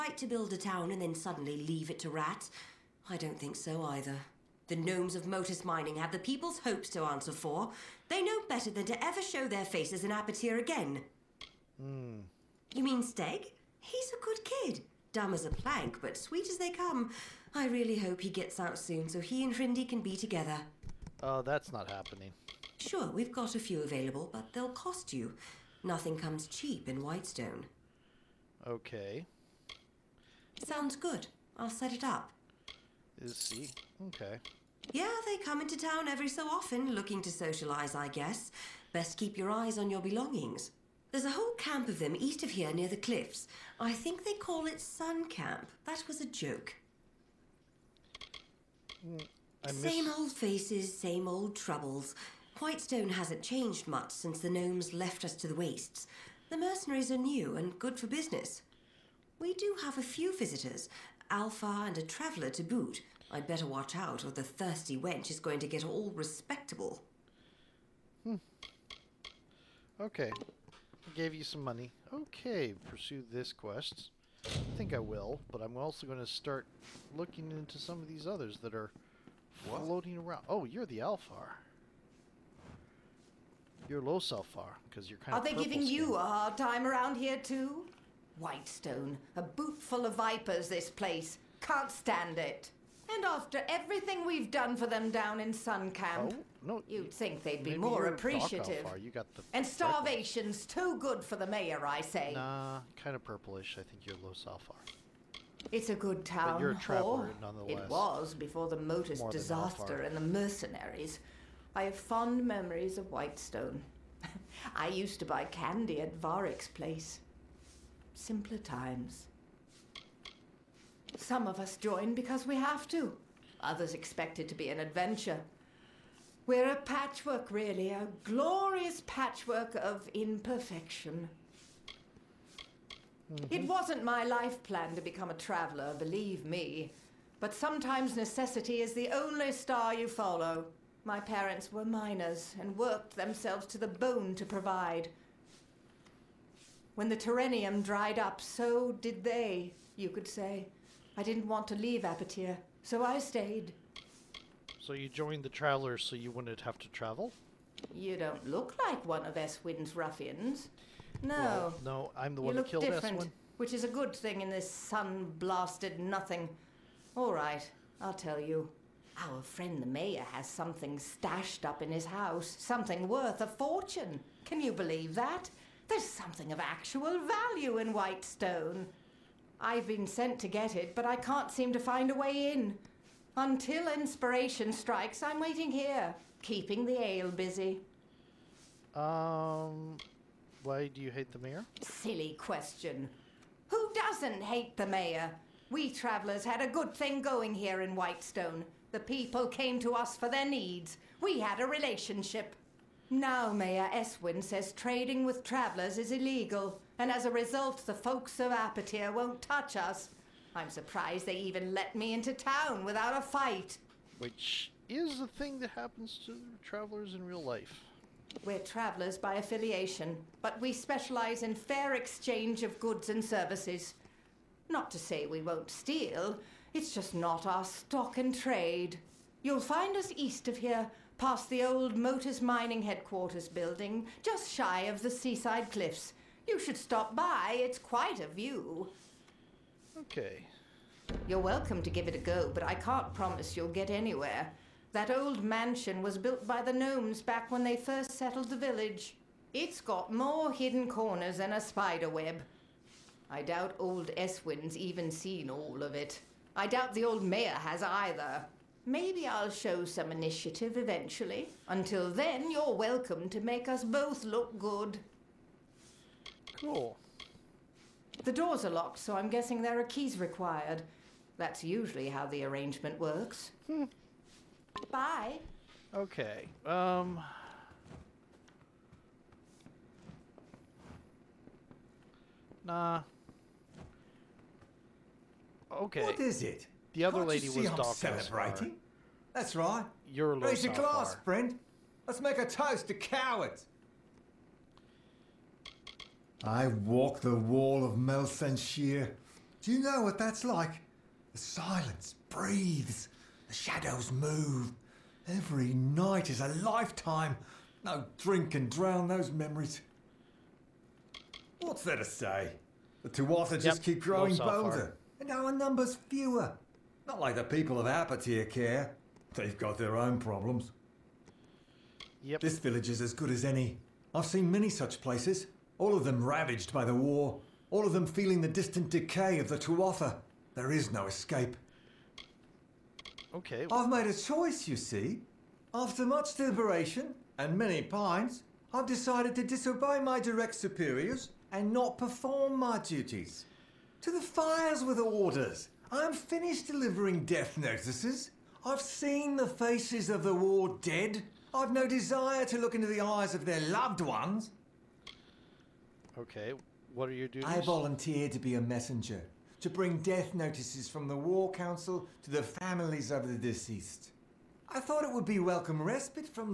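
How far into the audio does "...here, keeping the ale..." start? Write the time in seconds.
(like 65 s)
185 s.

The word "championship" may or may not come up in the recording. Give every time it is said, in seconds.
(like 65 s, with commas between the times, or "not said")
not said.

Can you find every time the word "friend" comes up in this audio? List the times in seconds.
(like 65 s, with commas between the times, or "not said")
169 s, 291 s.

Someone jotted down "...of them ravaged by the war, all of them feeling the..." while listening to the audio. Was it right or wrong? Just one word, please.
right.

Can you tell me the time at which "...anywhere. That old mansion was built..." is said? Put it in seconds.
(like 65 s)
243 s.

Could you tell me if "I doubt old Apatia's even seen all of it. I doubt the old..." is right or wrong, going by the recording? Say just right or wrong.
wrong.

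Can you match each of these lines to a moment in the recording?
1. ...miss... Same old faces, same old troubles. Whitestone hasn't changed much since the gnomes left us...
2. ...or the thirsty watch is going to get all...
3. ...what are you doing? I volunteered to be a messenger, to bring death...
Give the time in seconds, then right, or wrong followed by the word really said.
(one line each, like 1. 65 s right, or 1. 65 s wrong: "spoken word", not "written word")
1. 49 s right
2. 64 s wrong: "wench", not "watch"
3. 356 s right.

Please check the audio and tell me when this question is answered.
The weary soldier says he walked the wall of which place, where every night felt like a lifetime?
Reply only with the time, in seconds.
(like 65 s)
297 s.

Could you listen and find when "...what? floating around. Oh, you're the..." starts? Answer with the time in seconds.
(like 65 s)
79 s.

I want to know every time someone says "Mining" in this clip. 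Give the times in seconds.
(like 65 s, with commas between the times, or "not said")
5 s, 232 s.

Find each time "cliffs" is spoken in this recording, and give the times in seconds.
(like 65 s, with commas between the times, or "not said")
42 s, 235 s.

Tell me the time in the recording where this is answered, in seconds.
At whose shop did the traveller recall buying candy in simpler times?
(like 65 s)
116 s.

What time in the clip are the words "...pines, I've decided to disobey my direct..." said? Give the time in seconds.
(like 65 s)
337 s.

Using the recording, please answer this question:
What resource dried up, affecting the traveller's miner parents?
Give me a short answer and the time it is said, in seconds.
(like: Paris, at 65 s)
Terrenium, at 147 s.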